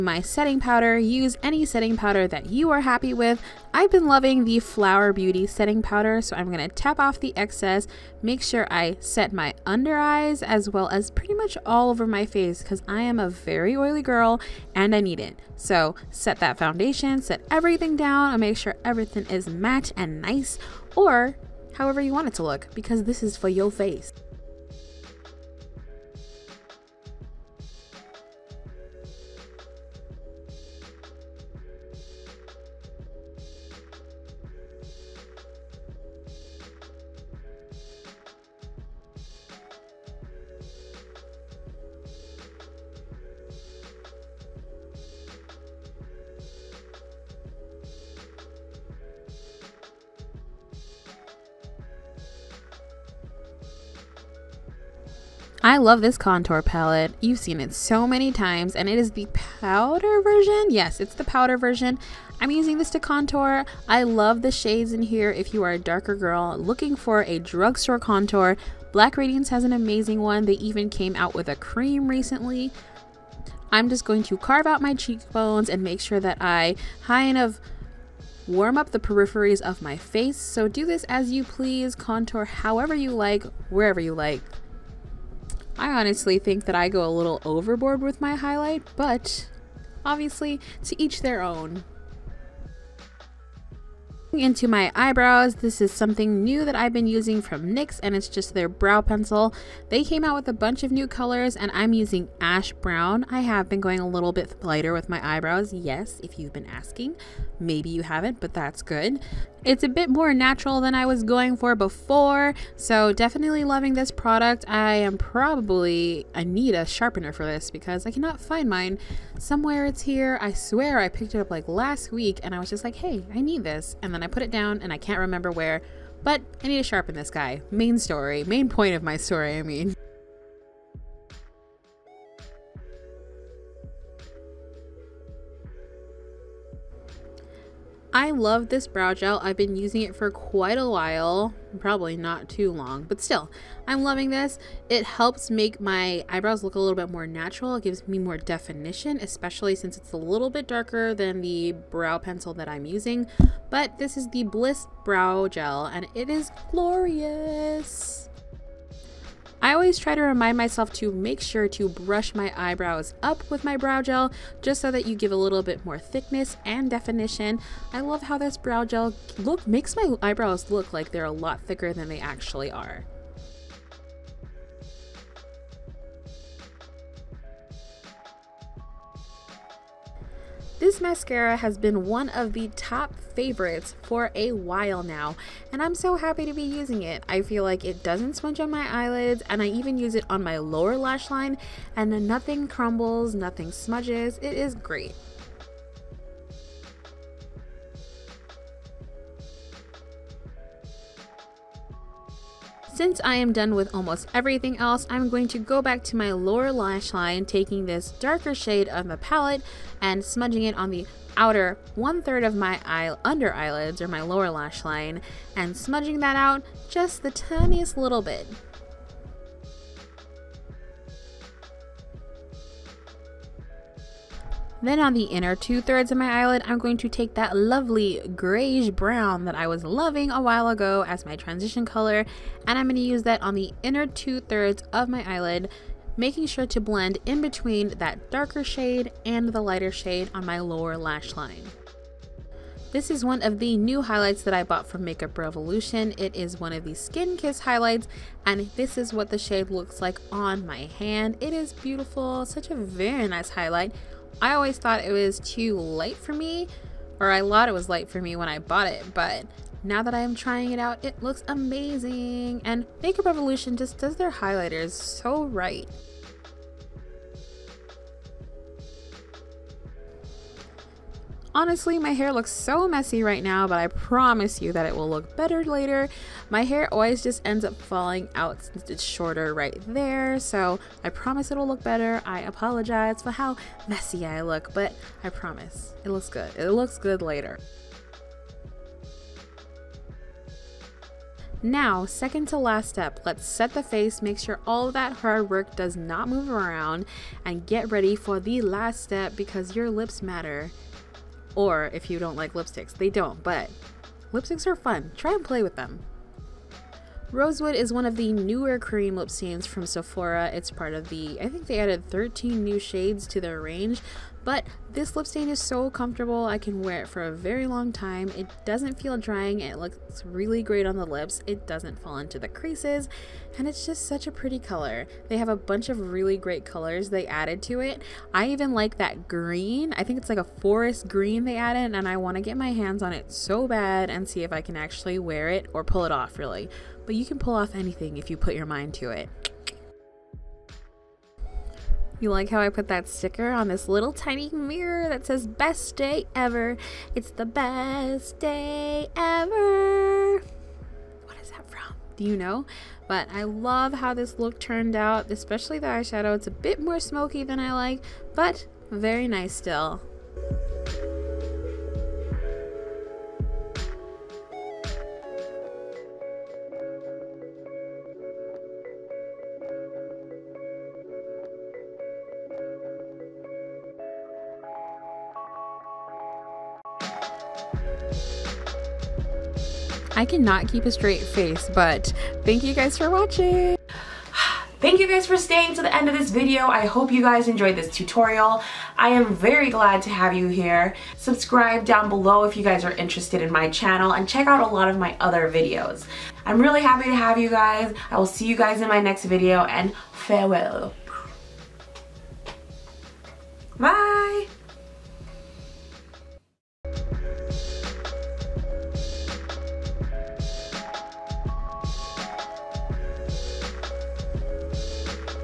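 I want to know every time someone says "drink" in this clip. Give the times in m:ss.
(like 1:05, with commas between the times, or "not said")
not said.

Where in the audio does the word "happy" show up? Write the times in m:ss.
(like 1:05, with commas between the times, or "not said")
0:02, 3:06, 6:36.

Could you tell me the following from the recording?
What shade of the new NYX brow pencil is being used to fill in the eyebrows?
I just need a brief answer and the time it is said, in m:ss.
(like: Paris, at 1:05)
ash brown, at 1:42.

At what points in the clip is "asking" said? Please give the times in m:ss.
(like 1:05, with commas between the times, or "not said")
1:46.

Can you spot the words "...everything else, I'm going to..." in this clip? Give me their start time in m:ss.
3:24.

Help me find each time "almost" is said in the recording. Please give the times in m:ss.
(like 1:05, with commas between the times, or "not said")
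3:23.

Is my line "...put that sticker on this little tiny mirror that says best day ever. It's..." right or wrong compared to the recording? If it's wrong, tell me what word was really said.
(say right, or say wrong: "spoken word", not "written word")
right.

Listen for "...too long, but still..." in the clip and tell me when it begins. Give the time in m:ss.
2:22.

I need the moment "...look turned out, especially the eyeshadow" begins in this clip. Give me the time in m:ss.
5:54.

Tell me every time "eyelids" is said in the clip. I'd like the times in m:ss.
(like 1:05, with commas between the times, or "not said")
3:08, 3:33, 3:46, 3:55.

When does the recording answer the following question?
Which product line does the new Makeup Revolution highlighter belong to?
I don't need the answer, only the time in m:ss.
4:06.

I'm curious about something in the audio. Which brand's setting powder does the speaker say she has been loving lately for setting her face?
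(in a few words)
Flower Beauty.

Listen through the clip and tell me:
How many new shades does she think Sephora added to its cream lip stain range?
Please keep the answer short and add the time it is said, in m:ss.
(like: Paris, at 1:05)
13, at 5:12.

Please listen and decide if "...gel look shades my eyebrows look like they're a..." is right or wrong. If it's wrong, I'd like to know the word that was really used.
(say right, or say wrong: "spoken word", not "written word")
wrong: "makes", not "shades".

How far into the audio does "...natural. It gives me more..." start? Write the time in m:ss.
2:27.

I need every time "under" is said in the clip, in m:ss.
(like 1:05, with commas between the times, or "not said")
0:09, 3:33.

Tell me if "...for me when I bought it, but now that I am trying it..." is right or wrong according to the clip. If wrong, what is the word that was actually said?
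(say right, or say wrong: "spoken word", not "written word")
right.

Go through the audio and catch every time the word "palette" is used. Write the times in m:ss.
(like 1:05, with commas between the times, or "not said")
0:56, 3:29.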